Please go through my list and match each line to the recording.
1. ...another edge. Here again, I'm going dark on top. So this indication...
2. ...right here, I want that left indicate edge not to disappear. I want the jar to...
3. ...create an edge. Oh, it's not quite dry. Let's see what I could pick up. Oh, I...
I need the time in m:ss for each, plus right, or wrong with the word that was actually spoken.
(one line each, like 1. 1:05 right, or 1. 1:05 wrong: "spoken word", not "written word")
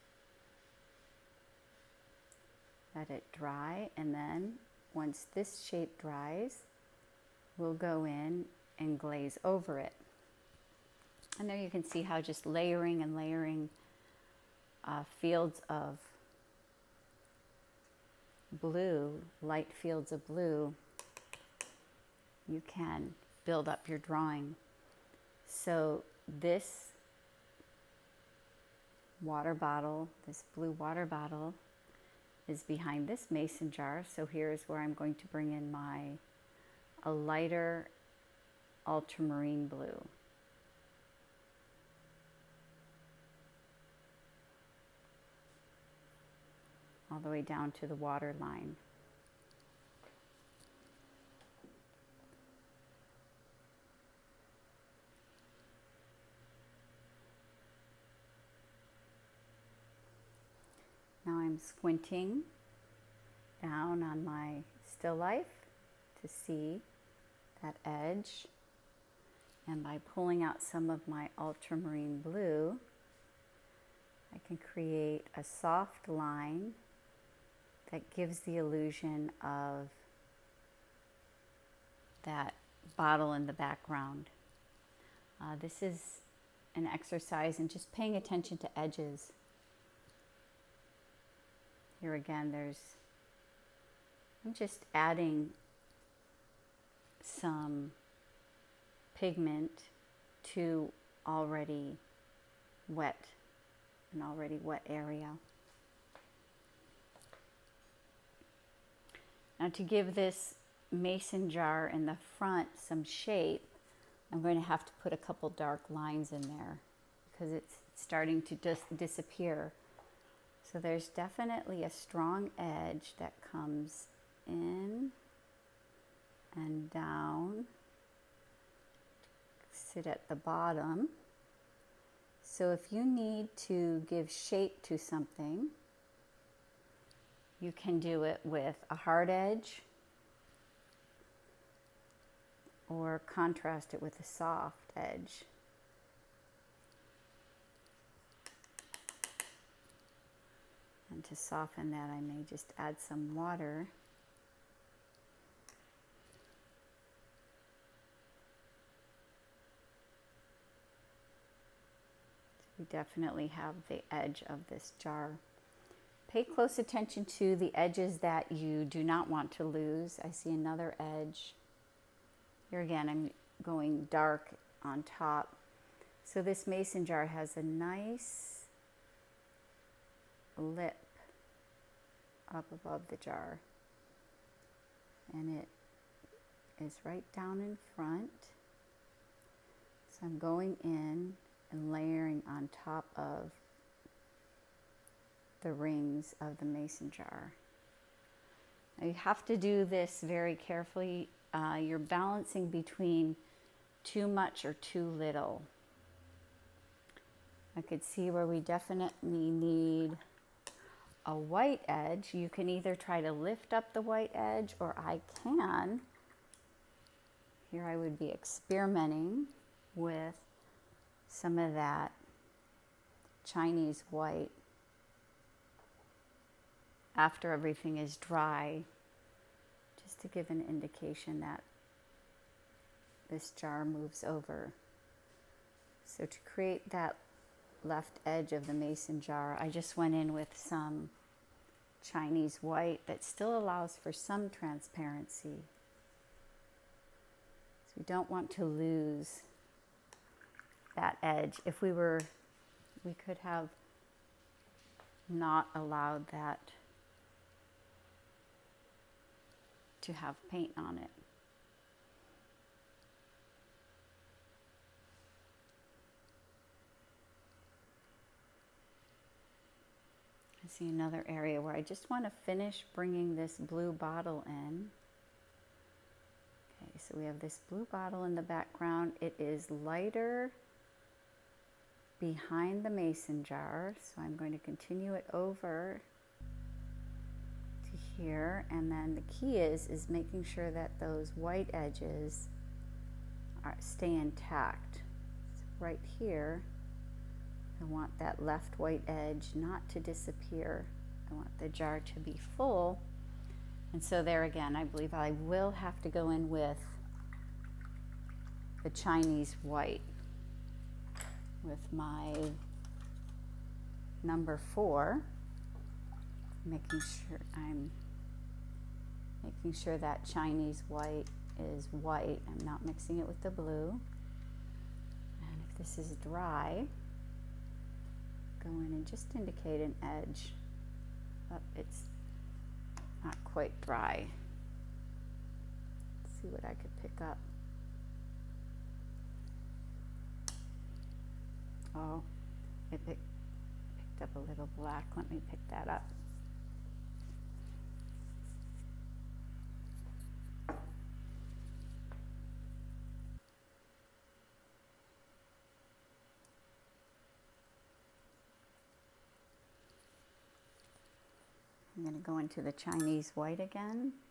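1. 2:50 wrong: "mason", not "indication"
2. 4:55 wrong: "white", not "indicate"
3. 5:29 wrong: "indicate", not "create".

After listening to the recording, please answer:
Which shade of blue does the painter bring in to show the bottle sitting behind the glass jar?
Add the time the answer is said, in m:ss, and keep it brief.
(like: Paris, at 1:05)
lighter ultramarine blue, at 0:37.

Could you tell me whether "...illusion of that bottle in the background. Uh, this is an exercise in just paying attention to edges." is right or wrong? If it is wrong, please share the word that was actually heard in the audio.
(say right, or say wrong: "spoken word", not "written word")
right.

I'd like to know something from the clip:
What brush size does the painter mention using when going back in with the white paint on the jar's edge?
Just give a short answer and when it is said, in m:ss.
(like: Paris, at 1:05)
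number 4, at 5:14.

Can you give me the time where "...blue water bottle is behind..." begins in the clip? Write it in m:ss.
0:30.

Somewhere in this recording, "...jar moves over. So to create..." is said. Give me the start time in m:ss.
3:53.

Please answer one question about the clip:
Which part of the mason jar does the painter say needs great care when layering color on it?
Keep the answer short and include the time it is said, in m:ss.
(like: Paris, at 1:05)
the rings, at 3:15.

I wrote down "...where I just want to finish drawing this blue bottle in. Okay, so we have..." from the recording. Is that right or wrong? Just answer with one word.
wrong.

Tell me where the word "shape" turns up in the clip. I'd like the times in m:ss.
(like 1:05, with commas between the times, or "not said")
0:05, 1:53, 2:14.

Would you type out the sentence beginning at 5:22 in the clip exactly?
I'm not mixing it with the blue.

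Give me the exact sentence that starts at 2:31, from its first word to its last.
And to soften that, I may just add some water.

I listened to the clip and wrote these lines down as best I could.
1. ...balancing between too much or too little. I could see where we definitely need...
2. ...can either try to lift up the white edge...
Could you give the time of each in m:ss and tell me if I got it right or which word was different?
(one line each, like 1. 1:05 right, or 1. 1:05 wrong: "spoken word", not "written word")
1. 3:21 right
2. 3:32 right.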